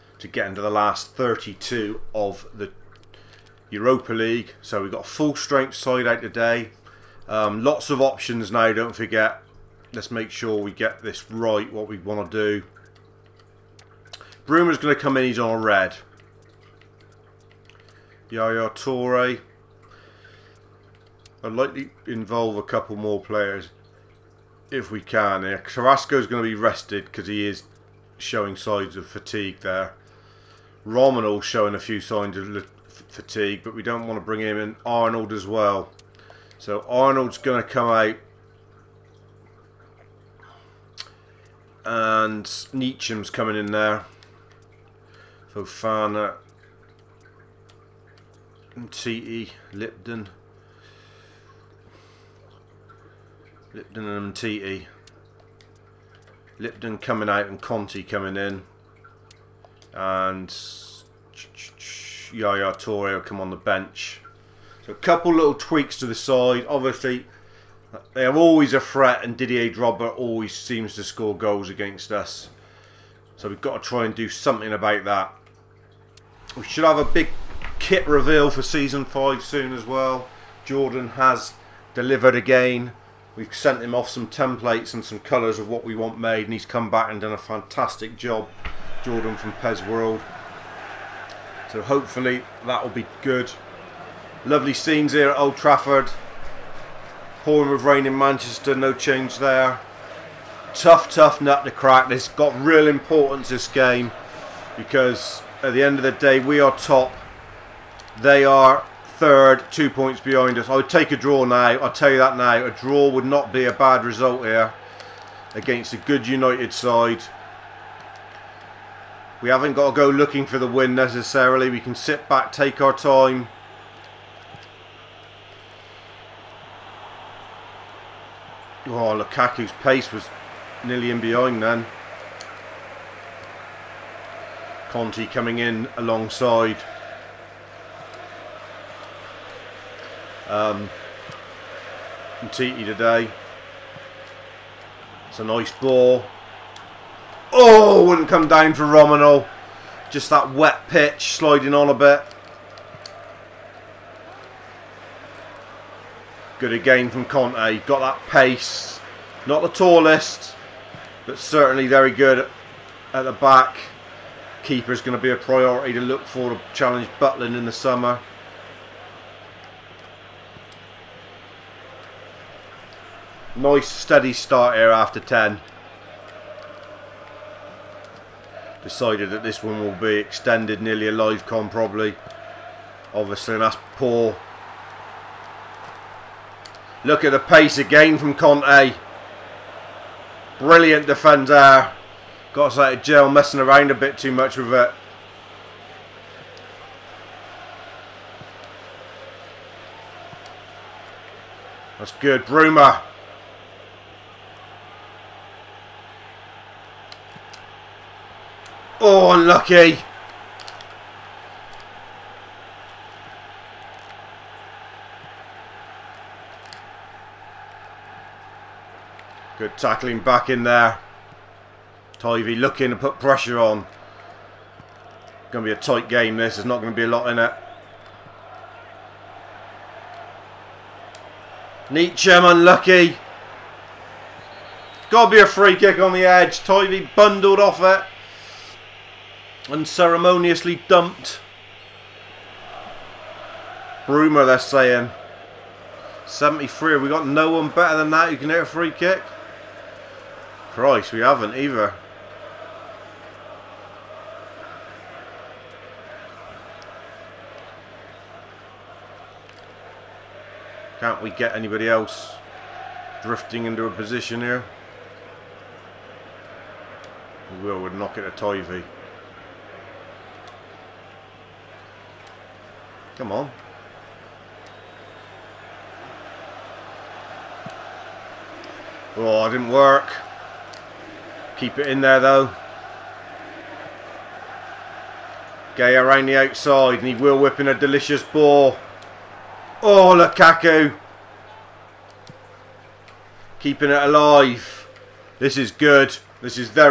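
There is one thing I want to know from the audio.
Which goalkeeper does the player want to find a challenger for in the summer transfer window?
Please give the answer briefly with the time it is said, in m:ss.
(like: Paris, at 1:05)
Butland, at 2:47.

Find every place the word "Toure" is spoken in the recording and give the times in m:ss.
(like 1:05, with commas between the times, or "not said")
0:18, 1:02.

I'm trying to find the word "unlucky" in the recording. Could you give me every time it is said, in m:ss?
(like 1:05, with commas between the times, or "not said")
3:29, 3:52.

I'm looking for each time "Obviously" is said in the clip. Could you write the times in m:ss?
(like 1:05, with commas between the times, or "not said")
1:06, 3:03.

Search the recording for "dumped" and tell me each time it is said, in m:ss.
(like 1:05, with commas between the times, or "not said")
4:00.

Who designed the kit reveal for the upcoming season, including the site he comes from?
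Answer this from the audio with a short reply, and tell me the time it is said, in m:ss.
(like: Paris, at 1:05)
Jordan from PES World, at 1:29.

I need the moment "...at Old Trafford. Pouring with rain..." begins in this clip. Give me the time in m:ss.
1:35.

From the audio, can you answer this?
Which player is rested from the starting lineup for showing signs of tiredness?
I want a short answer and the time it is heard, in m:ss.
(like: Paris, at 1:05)
Carrasco, at 0:25.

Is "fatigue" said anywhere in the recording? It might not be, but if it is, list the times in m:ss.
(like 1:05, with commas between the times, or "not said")
0:29, 0:33.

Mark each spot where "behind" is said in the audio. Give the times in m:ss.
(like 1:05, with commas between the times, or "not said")
1:50, 2:11.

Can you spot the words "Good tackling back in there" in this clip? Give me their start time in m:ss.
3:39.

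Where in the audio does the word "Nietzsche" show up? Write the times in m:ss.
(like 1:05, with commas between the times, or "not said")
3:51.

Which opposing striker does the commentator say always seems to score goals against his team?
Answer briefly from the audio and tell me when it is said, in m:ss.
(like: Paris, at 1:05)
Didier Drogba, at 1:09.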